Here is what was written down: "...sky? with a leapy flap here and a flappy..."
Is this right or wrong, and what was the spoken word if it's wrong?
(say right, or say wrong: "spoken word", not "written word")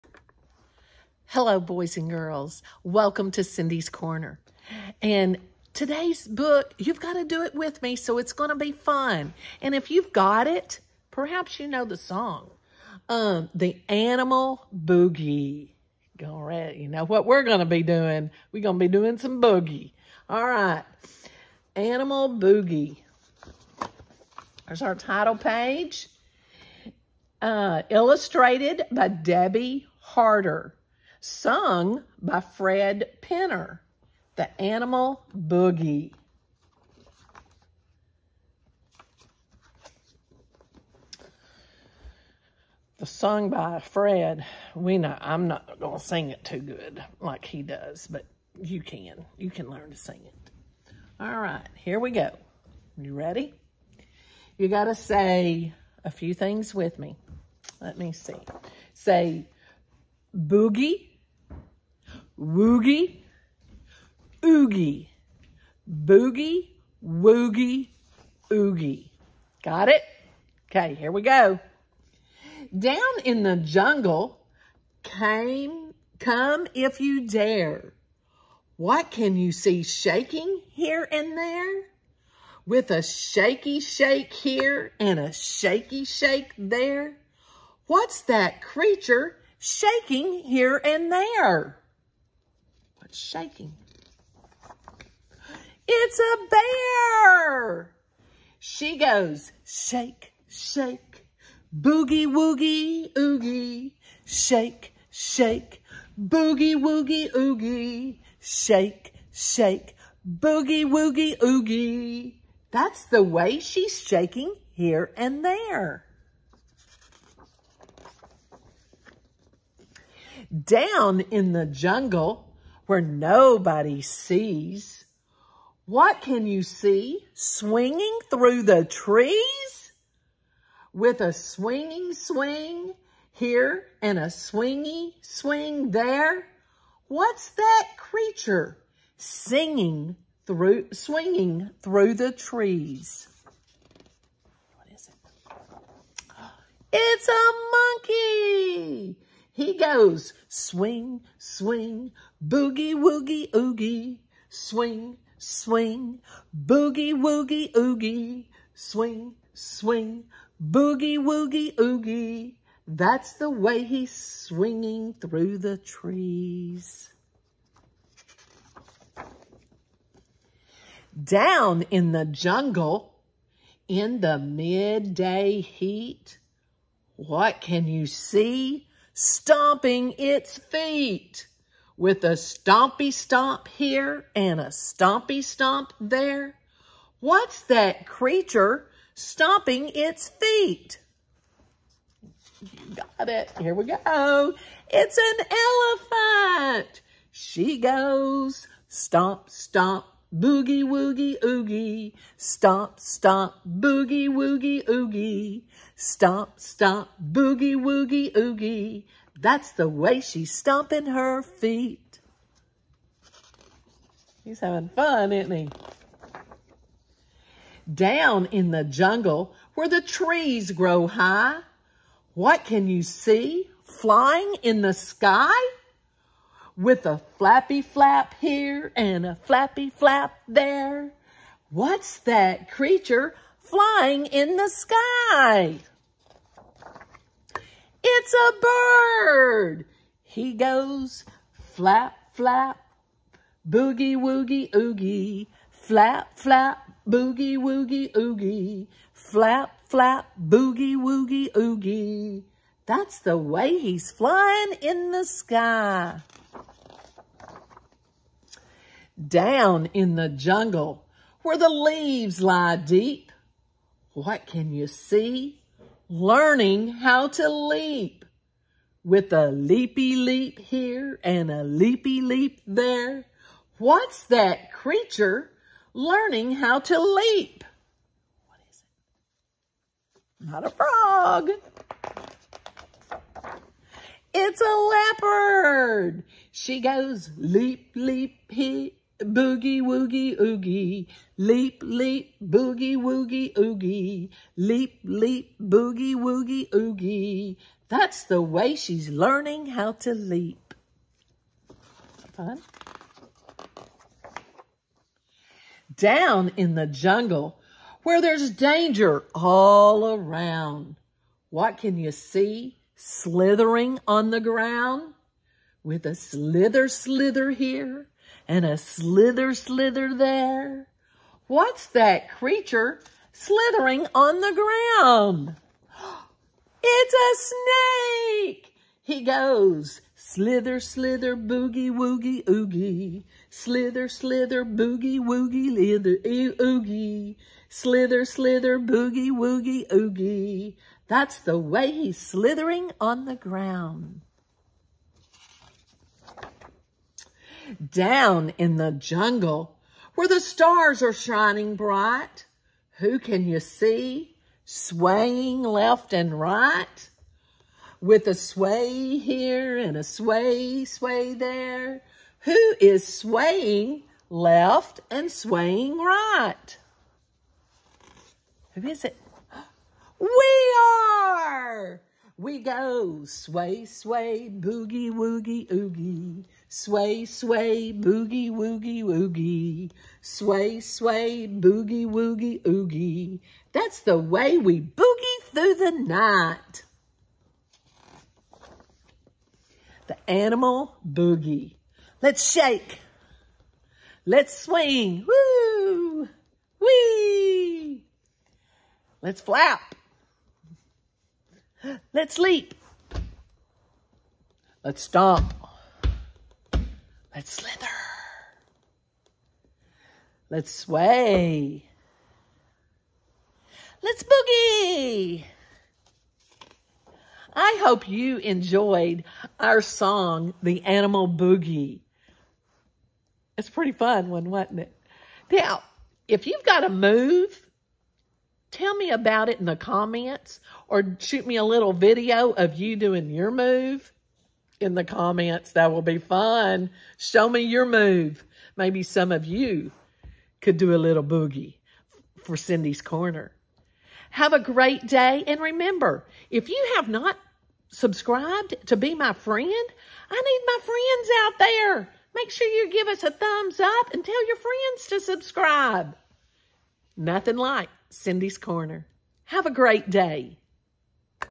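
wrong: "flappy", not "leapy".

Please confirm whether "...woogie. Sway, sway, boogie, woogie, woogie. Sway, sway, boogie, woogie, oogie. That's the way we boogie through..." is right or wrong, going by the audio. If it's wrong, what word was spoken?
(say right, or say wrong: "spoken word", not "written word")
wrong: "oogie", not "woogie".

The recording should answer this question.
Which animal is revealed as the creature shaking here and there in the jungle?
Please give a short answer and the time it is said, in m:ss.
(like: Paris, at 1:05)
Bear, at 1:36.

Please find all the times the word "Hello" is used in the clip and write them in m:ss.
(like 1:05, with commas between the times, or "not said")
0:01.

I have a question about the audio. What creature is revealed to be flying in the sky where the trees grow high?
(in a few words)
Bird.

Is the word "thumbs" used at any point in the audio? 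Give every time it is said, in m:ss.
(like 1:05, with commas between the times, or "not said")
7:33.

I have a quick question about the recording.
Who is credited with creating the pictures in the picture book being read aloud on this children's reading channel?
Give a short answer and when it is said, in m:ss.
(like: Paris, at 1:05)
Debbie Harter, at 0:29.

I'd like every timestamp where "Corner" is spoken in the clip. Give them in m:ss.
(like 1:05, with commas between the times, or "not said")
0:03, 7:23, 7:38.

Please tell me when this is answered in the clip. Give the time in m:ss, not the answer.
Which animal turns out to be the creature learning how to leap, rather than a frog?
4:45.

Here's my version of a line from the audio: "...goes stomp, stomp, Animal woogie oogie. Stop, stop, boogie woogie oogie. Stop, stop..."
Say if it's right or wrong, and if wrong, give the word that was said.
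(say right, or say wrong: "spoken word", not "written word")
wrong: "Boogie", not "Animal".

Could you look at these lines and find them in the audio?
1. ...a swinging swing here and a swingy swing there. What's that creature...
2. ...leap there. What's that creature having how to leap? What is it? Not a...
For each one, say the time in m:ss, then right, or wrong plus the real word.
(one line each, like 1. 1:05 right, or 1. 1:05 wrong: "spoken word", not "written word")
1. 2:11 right
2. 4:32 wrong: "learning", not "having".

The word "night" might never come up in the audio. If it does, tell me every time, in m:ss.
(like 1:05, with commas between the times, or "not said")
6:25.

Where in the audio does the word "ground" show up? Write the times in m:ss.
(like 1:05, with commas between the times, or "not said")
5:14, 5:24, 5:43.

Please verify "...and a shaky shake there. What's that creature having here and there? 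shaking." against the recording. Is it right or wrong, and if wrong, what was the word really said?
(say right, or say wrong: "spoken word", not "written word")
wrong: "shaking", not "having".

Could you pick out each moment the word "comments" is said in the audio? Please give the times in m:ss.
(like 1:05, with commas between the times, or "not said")
7:09, 7:15.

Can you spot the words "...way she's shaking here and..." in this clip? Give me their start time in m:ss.
1:53.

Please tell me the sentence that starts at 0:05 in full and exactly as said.
And today's book, you've got to do it with me, so it's going to be fun.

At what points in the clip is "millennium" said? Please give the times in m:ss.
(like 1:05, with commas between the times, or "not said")
not said.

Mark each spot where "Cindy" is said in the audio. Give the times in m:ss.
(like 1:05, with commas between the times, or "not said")
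0:03, 7:22, 7:38.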